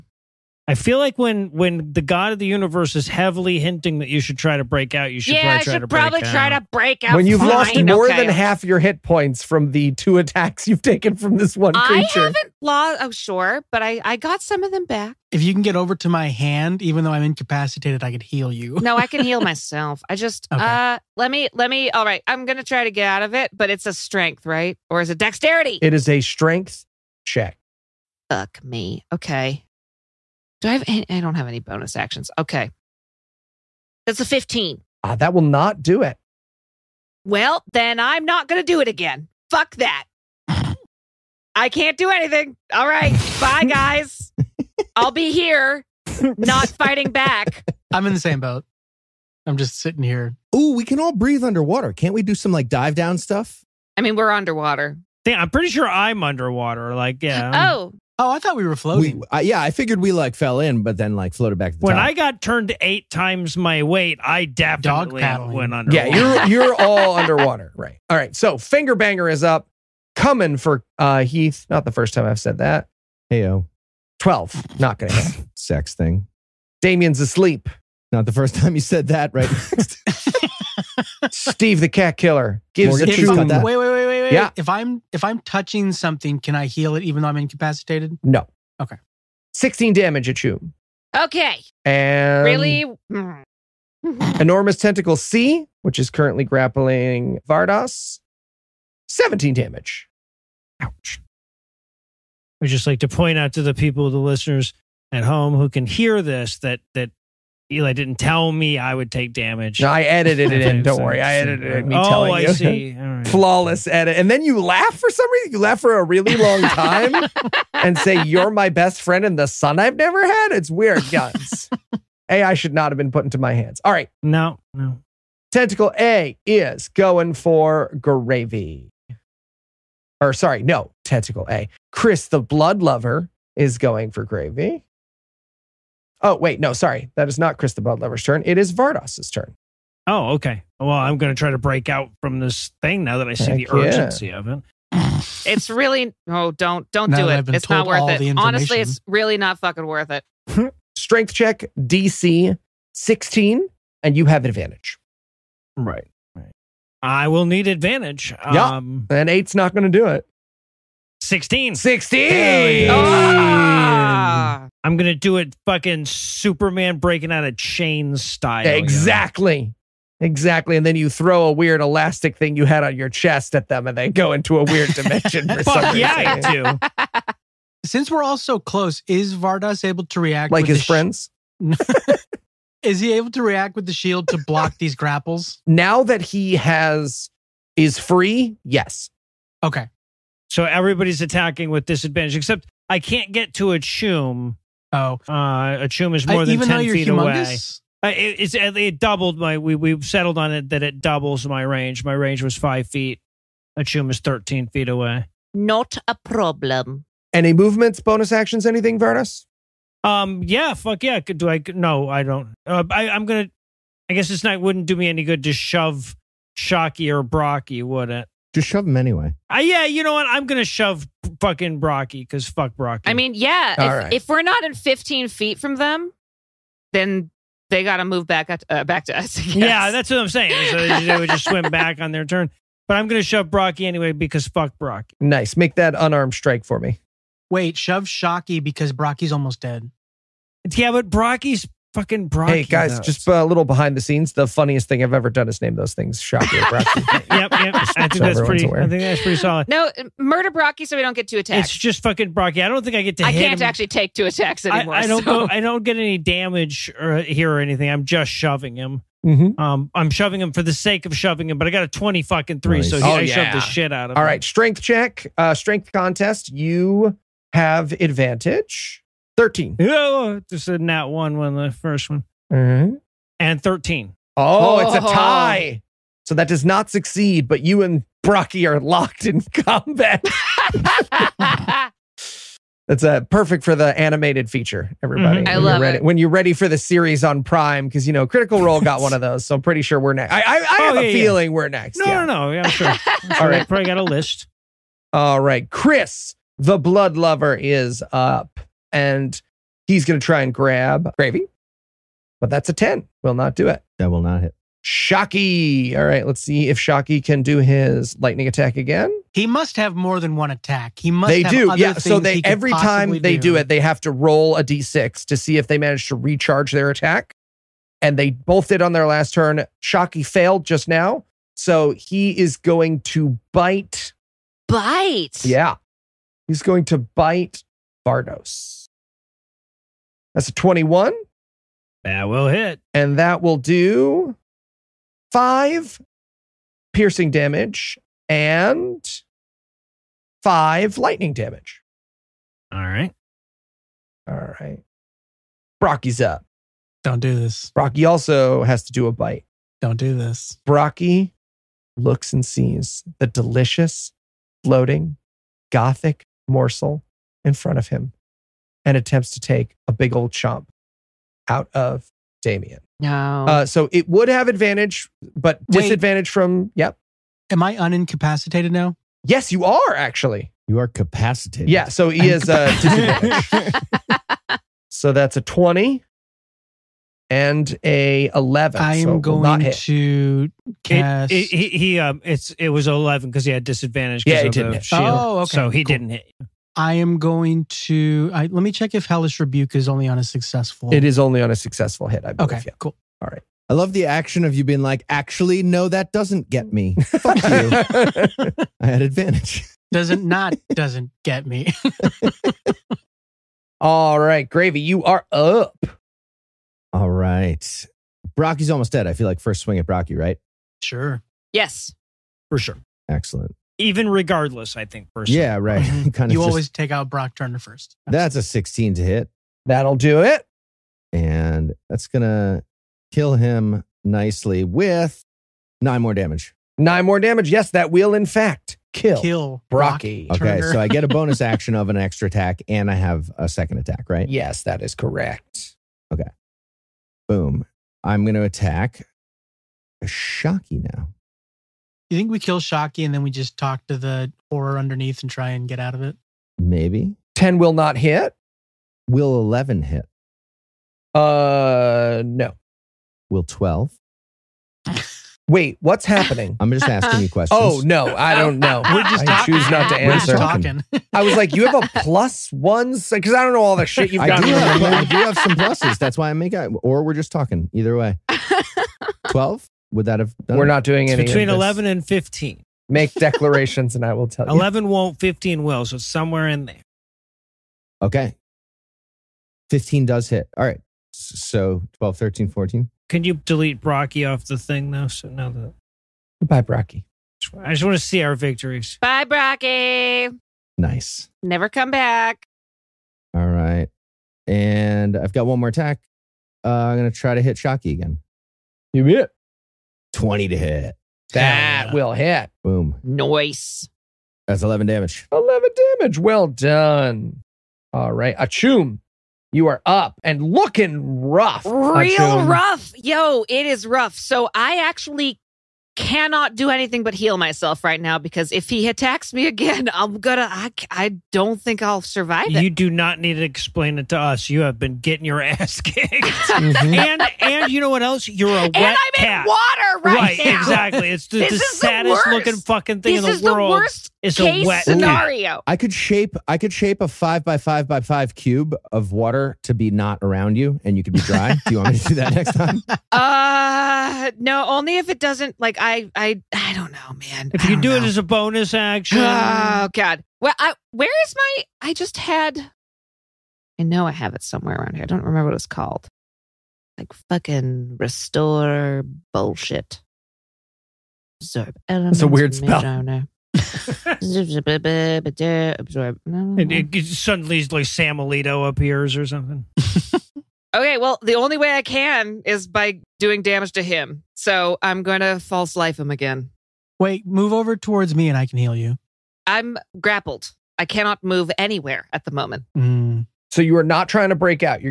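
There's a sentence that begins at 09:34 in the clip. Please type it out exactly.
So I'm going to false life him again.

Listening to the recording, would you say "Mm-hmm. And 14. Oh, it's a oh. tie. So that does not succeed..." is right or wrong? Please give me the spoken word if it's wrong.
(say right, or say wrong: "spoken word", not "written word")
wrong: "13", not "14".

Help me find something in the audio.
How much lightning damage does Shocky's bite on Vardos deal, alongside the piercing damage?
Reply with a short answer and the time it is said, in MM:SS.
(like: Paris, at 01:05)
5, at 05:40.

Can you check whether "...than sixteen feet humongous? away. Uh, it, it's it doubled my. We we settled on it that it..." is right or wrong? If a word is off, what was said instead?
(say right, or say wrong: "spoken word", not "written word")
wrong: "ten", not "sixteen".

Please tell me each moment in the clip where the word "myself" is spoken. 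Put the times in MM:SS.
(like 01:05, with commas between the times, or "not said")
00:19, 08:37.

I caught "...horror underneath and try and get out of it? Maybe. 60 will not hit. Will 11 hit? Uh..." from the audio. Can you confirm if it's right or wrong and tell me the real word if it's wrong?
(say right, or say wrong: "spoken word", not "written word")
wrong: "10", not "60".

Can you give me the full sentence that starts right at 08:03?
Can you delete Brocky off the thing now?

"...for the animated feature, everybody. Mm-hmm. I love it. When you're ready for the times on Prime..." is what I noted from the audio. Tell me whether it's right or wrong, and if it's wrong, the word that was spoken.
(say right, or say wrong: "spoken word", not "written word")
wrong: "series", not "times".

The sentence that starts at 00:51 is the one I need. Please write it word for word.
Can't we do some like dive down stuff?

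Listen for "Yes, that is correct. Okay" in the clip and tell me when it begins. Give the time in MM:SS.
07:14.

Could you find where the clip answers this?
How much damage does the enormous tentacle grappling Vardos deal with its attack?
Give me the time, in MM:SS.
01:39.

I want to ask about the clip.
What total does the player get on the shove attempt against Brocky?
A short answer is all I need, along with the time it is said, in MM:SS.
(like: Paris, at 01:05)
23, at 04:21.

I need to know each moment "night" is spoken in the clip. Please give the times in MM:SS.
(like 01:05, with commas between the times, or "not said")
03:34.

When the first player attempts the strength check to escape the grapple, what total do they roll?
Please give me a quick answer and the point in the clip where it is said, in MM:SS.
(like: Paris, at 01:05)
15, at 00:34.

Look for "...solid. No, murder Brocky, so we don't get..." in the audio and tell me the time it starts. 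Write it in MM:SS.
04:09.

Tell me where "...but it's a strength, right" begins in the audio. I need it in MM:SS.
00:23.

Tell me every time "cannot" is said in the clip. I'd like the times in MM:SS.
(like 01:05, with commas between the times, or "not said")
08:35, 09:40.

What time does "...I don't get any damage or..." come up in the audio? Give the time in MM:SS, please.
04:15.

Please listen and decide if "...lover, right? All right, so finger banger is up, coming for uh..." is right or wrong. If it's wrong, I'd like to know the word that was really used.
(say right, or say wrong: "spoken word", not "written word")
wrong: "underwater", not "lover".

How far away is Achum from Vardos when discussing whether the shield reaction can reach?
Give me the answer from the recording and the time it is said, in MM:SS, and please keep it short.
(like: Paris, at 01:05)
13 feet, at 03:24.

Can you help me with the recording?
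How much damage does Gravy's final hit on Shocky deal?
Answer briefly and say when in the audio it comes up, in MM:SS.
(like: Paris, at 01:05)
11, at 08:24.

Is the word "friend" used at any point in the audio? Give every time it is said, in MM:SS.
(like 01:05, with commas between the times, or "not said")
01:59, 03:00.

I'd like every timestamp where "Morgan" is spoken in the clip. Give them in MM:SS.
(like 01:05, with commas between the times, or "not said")
01:22.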